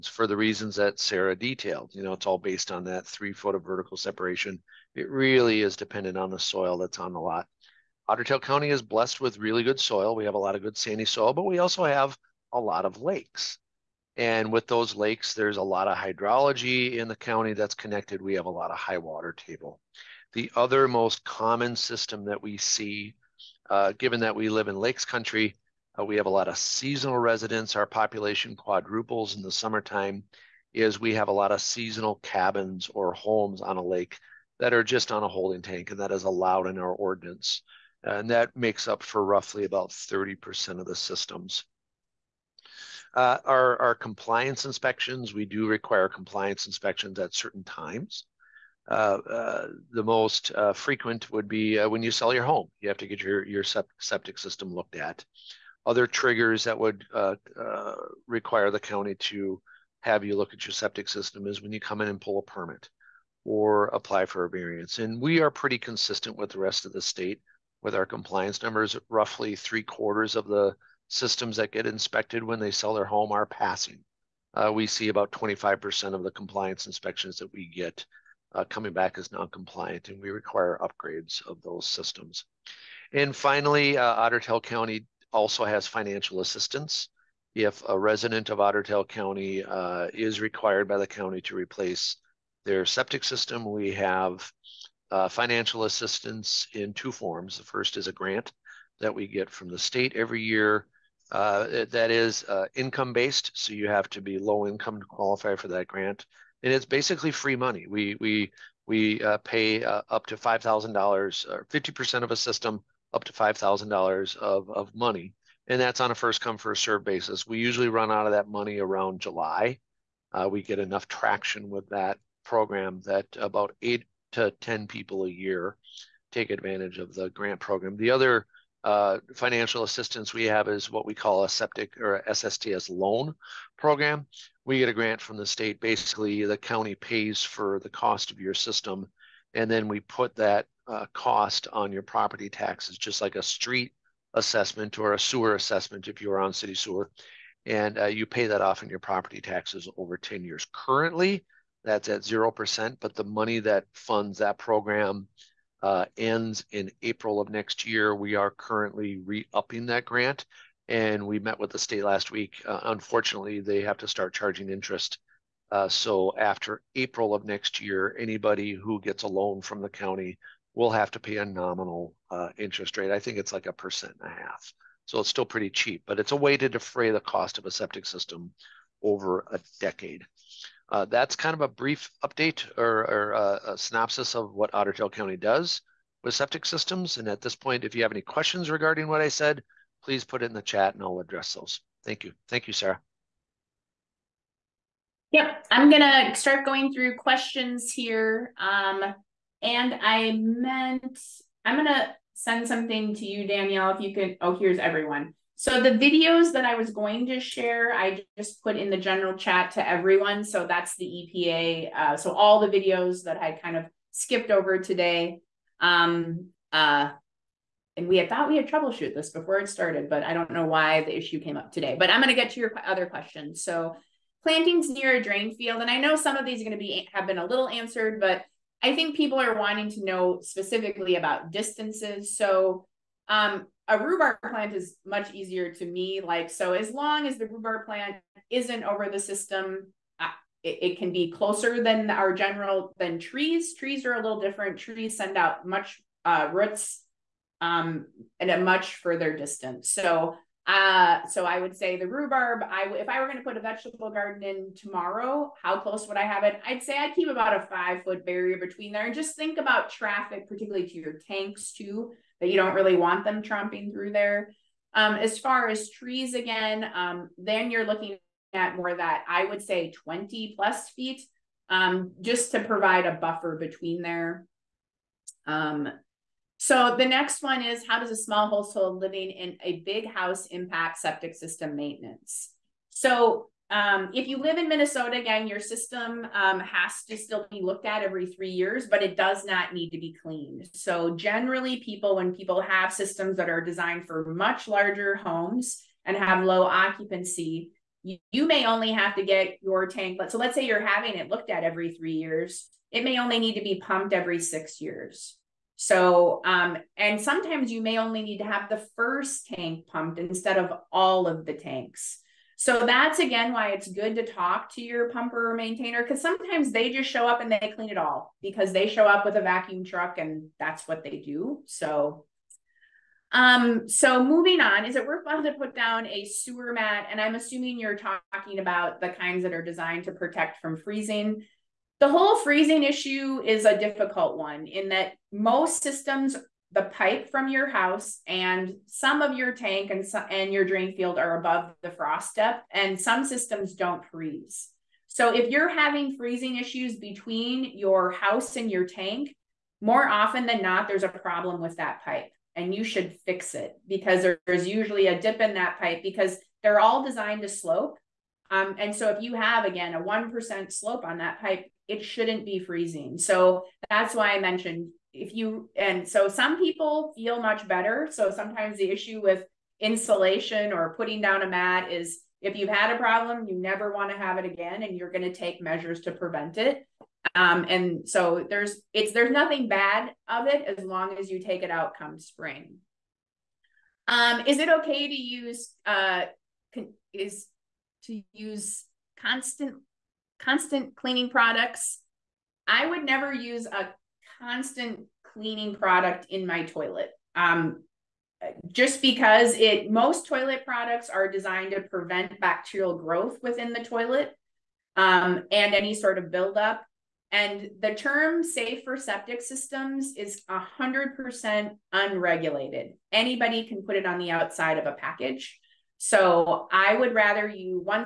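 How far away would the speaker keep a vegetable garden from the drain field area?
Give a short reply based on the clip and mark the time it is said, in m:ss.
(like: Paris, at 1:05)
5 feet, at 4:17.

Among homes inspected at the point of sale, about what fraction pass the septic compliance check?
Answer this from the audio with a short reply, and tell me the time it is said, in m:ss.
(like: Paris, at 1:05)
three quarters, at 1:09.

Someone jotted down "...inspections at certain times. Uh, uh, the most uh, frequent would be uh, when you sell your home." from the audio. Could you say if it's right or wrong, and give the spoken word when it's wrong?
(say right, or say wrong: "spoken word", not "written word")
right.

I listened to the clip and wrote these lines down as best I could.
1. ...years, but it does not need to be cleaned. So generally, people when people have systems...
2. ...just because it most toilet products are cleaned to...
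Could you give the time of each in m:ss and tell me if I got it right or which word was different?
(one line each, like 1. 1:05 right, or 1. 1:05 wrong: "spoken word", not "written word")
1. 4:48 right
2. 6:38 wrong: "designed", not "cleaned".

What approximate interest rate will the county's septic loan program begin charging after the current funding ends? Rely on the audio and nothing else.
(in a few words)
1.5%.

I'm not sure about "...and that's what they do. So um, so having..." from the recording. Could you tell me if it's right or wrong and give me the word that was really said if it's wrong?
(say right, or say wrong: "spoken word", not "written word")
wrong: "moving", not "having".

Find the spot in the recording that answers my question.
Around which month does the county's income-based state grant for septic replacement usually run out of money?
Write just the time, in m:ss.
1:59.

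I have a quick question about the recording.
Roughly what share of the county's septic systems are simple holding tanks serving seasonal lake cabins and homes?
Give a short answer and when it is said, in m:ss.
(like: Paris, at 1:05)
30%, at 0:39.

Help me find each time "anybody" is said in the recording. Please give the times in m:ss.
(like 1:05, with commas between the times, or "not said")
2:48, 6:53.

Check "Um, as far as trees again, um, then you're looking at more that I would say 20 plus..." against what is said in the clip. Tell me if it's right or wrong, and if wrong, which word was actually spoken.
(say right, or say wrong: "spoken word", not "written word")
right.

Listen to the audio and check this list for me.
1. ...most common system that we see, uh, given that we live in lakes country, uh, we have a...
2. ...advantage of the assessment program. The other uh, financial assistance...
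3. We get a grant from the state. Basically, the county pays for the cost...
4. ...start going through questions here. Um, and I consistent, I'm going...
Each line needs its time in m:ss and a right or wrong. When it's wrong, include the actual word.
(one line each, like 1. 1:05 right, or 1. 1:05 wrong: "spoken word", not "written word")
1. 0:20 right
2. 2:06 wrong: "grant", not "assessment"
3. 2:14 right
4. 3:16 wrong: "meant", not "consistent".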